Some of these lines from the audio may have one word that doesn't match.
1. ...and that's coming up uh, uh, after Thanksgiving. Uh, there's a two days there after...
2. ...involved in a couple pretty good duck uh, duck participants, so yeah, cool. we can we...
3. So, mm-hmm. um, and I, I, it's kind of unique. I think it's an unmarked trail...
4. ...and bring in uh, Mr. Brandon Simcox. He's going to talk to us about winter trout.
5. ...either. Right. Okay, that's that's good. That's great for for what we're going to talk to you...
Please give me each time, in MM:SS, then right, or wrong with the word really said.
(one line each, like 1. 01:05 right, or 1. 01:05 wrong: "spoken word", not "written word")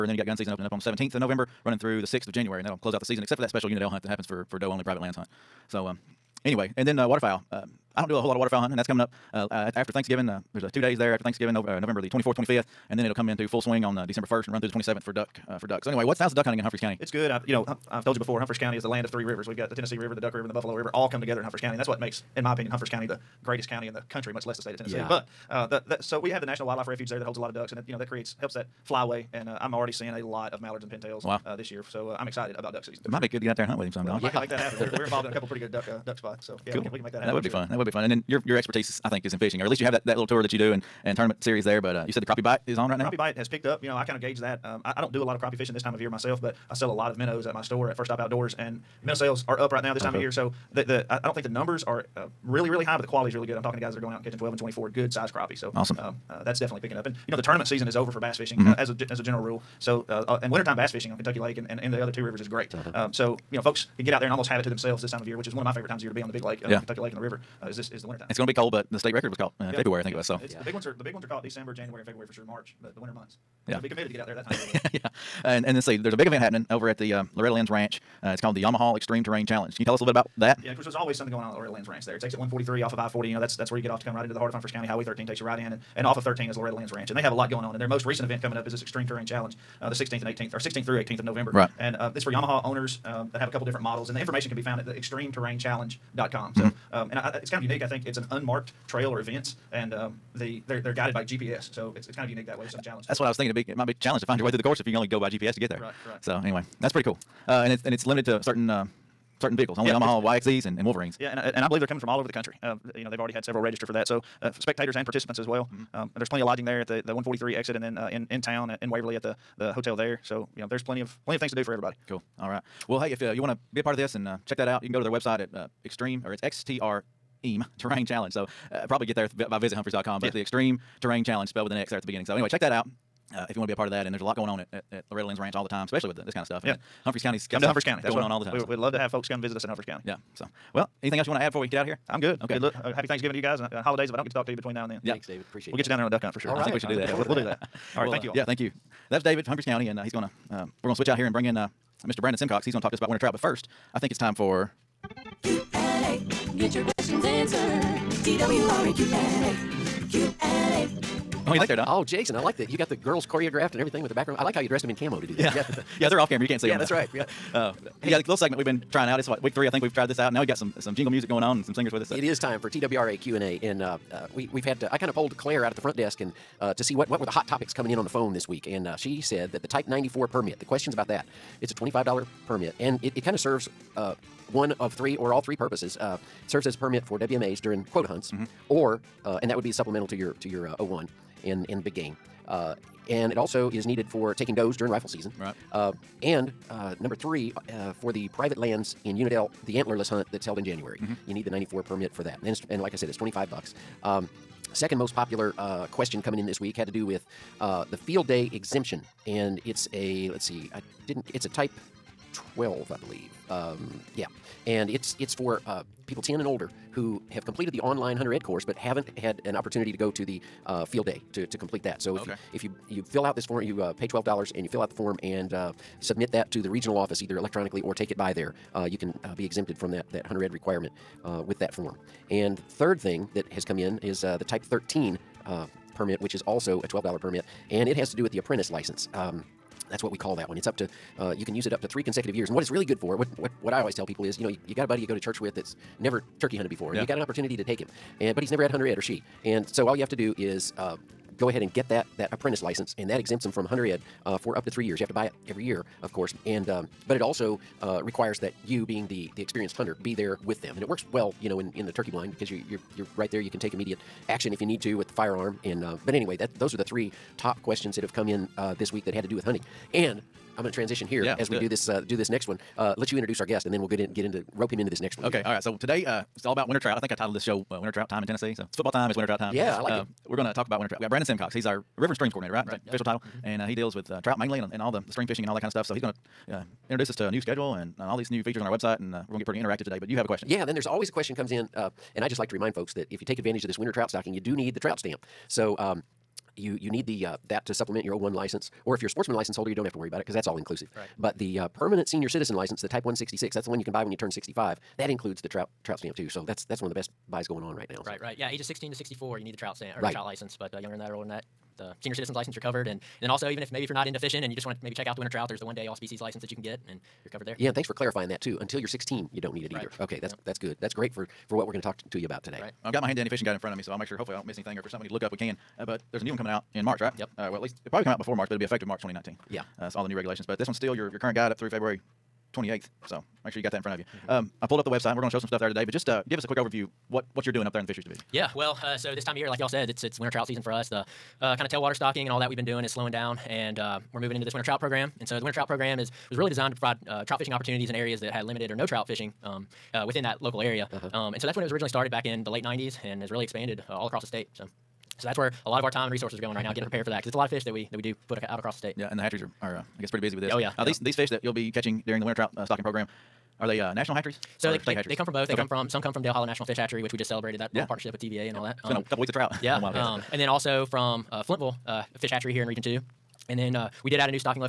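1. 00:08 right
2. 00:35 wrong: "spots", not "participants"
3. 01:36 right
4. 02:31 right
5. 05:19 right.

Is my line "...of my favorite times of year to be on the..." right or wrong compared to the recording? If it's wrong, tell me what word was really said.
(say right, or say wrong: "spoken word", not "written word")
right.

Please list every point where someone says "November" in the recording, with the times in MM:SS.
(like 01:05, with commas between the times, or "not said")
00:01, 00:11, 01:31.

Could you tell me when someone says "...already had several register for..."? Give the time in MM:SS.
01:53.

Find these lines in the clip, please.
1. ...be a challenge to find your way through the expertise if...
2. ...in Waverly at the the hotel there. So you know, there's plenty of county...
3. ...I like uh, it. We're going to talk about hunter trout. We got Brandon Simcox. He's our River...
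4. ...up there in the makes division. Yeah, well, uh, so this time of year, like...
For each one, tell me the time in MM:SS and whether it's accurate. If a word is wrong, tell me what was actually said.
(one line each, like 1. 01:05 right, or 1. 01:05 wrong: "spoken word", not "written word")
1. 01:43 wrong: "course", not "expertise"
2. 01:58 wrong: "plenty", not "county"
3. 04:39 wrong: "winter", not "hunter"
4. 05:37 wrong: "fisheries", not "makes".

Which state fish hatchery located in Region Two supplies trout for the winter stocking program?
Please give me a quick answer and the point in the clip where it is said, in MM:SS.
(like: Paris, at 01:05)
Flintville, at 06:11.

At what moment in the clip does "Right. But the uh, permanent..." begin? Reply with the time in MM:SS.
05:00.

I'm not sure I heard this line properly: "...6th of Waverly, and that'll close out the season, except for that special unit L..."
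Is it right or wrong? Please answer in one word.
wrong.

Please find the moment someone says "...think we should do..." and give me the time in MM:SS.
02:26.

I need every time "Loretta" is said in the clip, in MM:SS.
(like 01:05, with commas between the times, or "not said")
01:17, 01:21, 01:26, 02:15.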